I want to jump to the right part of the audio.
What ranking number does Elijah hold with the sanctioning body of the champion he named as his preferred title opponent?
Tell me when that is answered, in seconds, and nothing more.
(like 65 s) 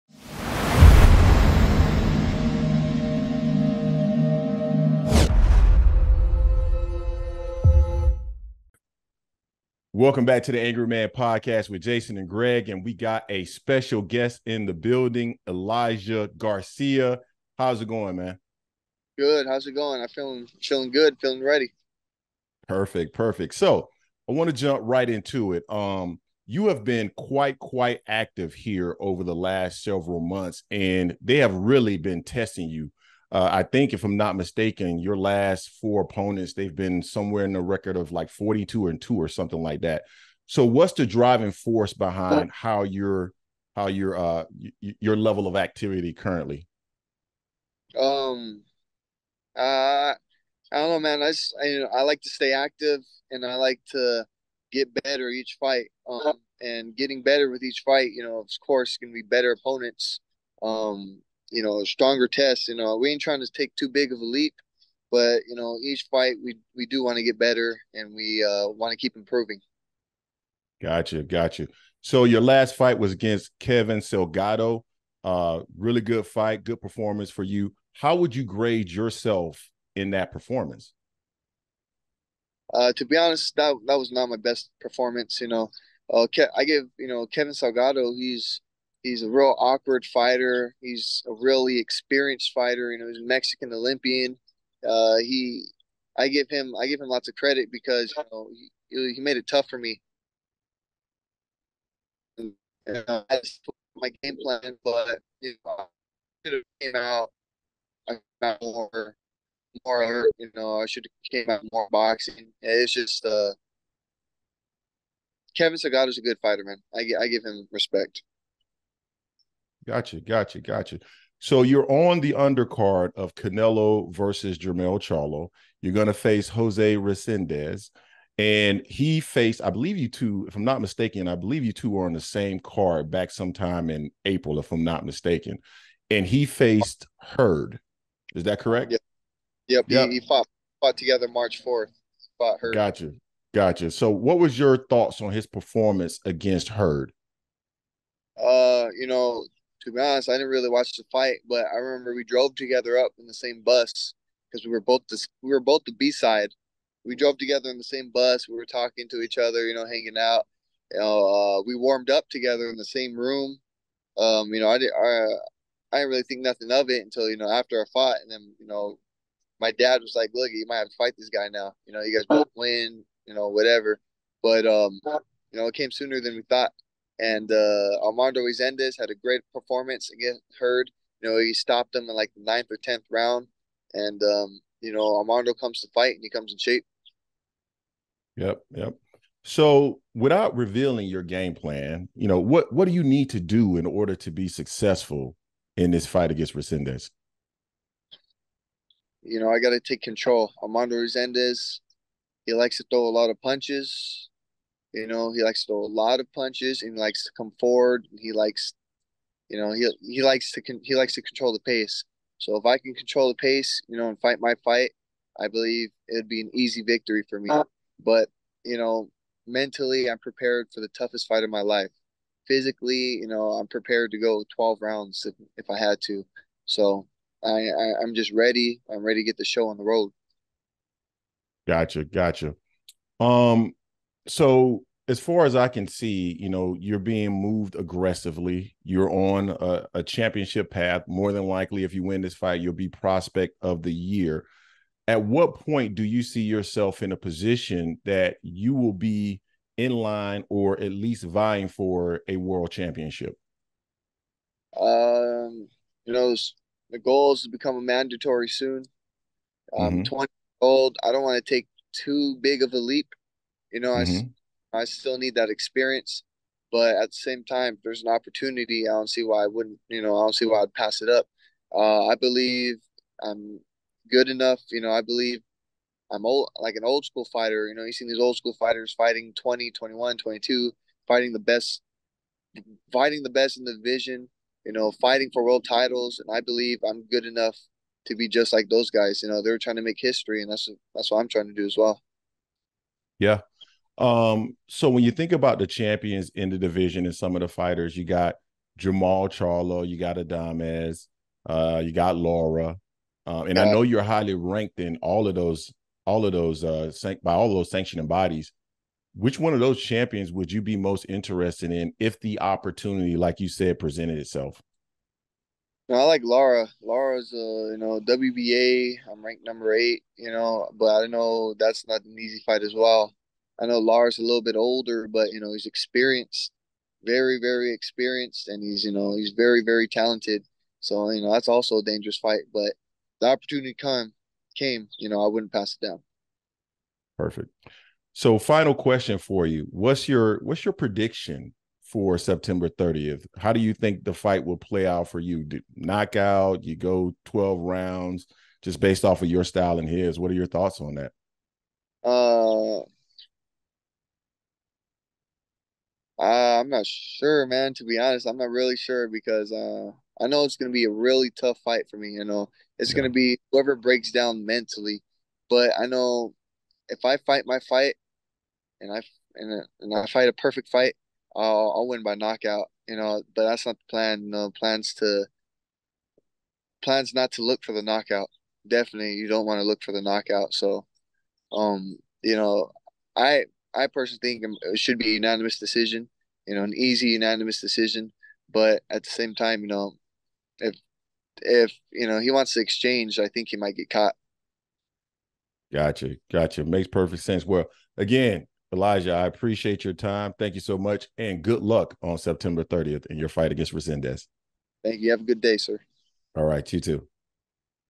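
319 s.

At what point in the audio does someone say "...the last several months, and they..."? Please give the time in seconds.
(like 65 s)
29 s.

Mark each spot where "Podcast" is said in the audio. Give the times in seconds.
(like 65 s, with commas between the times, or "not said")
11 s.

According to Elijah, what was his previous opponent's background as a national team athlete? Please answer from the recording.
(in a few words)
Mexican Olympian.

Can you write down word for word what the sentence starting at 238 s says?
You're on a, a, championship path.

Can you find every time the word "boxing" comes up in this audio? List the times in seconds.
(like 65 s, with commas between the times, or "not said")
111 s.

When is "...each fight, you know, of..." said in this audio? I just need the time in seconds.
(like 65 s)
57 s.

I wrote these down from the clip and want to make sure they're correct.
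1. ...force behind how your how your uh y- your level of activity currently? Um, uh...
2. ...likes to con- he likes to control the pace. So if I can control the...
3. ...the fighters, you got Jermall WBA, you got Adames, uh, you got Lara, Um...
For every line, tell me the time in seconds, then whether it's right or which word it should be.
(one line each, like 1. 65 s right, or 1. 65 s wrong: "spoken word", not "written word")
1. 41 s right
2. 210 s right
3. 297 s wrong: "Charlo", not "WBA".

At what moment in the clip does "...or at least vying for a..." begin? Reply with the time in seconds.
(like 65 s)
250 s.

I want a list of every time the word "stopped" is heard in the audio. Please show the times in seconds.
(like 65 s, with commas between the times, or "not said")
181 s.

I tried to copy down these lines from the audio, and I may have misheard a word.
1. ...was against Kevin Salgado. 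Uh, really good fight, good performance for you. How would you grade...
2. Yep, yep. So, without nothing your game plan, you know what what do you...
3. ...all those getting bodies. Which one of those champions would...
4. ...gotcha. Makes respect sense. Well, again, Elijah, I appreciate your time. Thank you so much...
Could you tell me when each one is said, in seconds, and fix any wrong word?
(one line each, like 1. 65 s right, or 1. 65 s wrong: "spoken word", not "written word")
1. 72 s right
2. 188 s wrong: "revealing", not "nothing"
3. 307 s wrong: "sanctioning", not "getting"
4. 396 s wrong: "perfect", not "respect".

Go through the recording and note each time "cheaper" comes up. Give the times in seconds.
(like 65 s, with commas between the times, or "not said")
not said.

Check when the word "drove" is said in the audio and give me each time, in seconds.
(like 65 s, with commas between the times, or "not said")
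152 s, 157 s.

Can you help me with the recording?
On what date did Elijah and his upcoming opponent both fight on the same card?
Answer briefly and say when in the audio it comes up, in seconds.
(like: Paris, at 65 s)
March 4th, at 141 s.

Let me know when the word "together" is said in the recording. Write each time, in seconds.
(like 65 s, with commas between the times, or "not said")
140 s, 152 s, 157 s, 162 s.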